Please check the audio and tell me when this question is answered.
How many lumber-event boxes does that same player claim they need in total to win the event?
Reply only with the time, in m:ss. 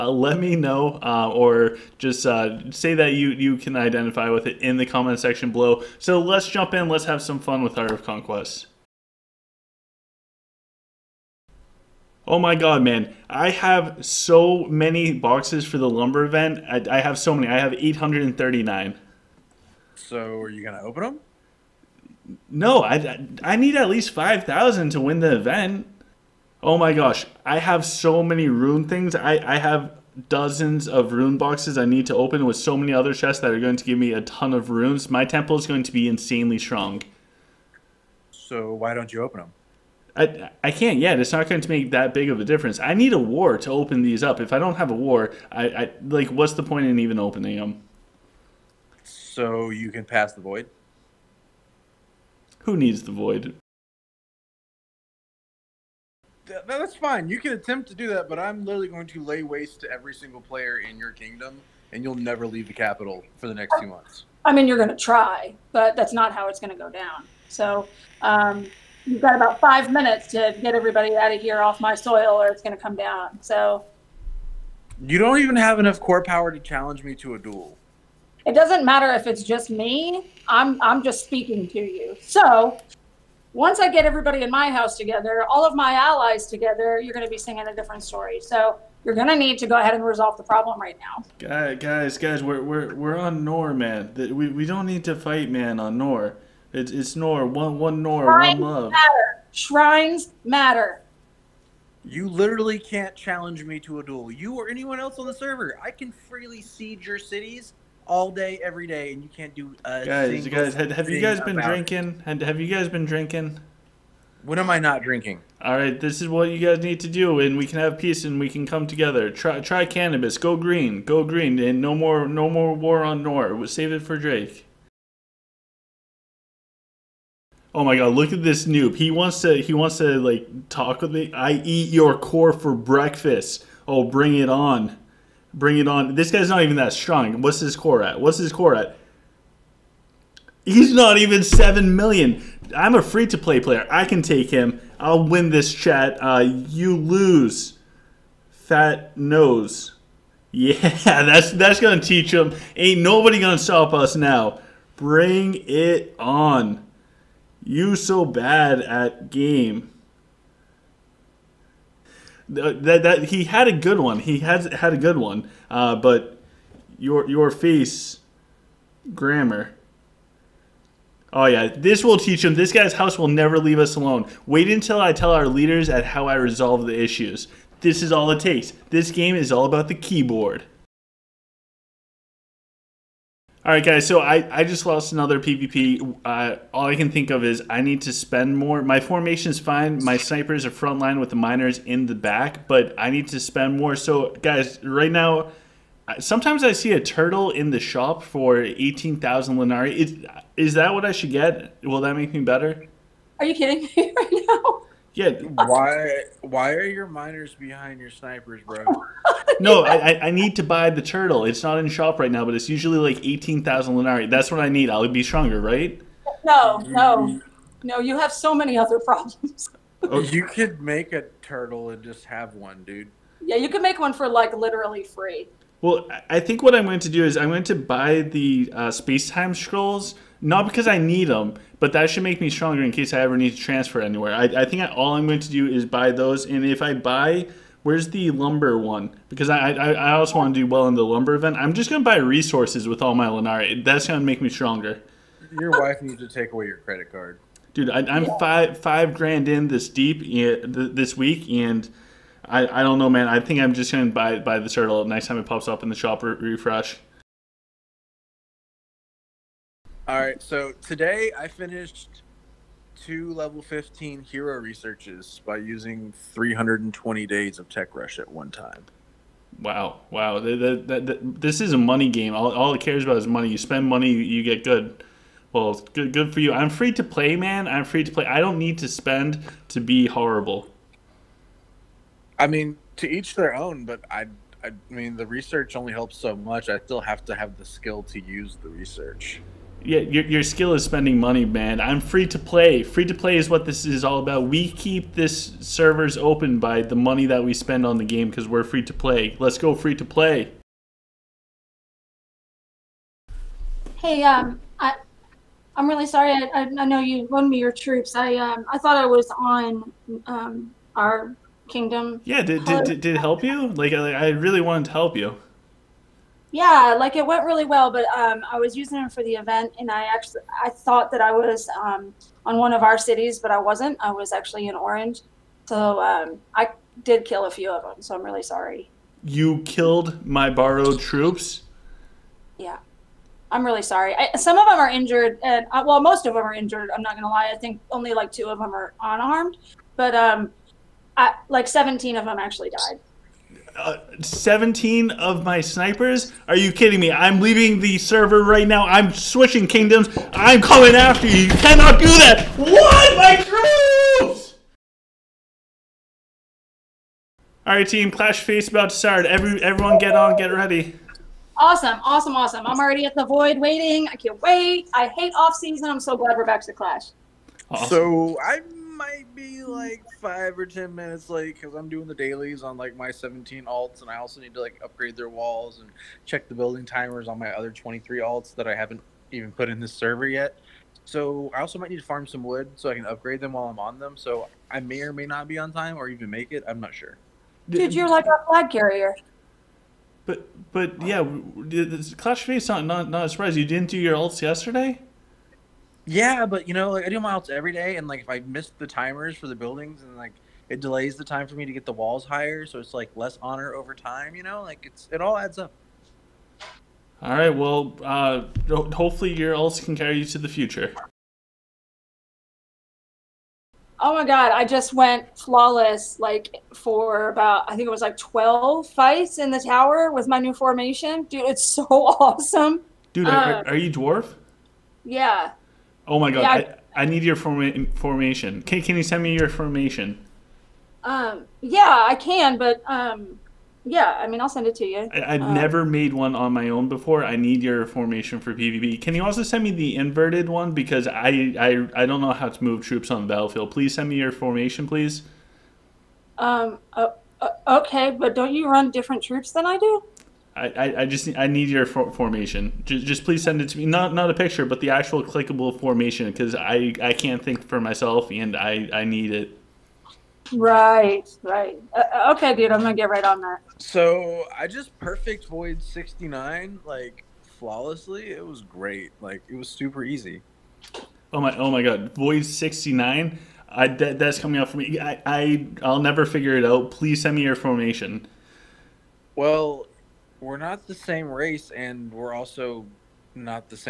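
0:24.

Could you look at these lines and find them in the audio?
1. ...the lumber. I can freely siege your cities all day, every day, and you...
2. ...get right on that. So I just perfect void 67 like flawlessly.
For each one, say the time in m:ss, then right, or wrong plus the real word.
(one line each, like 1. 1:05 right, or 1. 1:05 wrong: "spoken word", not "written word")
1. 1:45 wrong: "server", not "lumber"
2. 7:42 wrong: "69", not "67".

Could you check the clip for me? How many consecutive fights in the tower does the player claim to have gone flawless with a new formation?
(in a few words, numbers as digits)
12.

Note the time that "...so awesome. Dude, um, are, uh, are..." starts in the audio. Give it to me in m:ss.
7:01.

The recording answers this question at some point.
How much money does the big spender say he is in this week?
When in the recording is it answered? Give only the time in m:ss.
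4:08.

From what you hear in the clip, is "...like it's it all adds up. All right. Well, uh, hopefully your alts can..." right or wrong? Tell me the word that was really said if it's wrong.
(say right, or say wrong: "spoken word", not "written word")
right.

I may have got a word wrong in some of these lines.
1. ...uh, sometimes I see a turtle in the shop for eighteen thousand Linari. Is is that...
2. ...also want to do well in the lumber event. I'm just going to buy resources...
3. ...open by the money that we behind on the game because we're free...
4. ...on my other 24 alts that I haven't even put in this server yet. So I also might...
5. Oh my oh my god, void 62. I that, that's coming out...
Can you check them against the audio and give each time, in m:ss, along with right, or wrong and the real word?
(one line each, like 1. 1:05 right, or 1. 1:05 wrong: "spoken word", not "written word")
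1. 3:16 right
2. 4:00 right
3. 4:56 wrong: "spend", not "behind"
4. 6:17 wrong: "23", not "24"
5. 7:51 wrong: "69", not "62".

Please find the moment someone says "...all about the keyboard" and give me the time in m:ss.
2:59.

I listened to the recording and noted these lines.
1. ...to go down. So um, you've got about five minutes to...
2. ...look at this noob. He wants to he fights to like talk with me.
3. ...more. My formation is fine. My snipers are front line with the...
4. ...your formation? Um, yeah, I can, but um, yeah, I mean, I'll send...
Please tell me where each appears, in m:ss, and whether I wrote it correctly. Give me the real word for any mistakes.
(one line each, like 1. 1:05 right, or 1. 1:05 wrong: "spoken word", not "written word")
1. 1:06 right
2. 2:08 wrong: "wants", not "fights"
3. 3:08 right
4. 7:09 right.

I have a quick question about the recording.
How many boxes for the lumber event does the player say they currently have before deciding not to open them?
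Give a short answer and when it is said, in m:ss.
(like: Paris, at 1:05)
839, at 0:17.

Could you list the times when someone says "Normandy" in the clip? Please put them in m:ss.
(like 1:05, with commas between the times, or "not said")
not said.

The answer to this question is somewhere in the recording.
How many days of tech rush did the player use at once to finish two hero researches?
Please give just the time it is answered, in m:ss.
4:26.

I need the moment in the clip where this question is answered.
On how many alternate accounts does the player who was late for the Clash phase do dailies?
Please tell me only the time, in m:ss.
6:13.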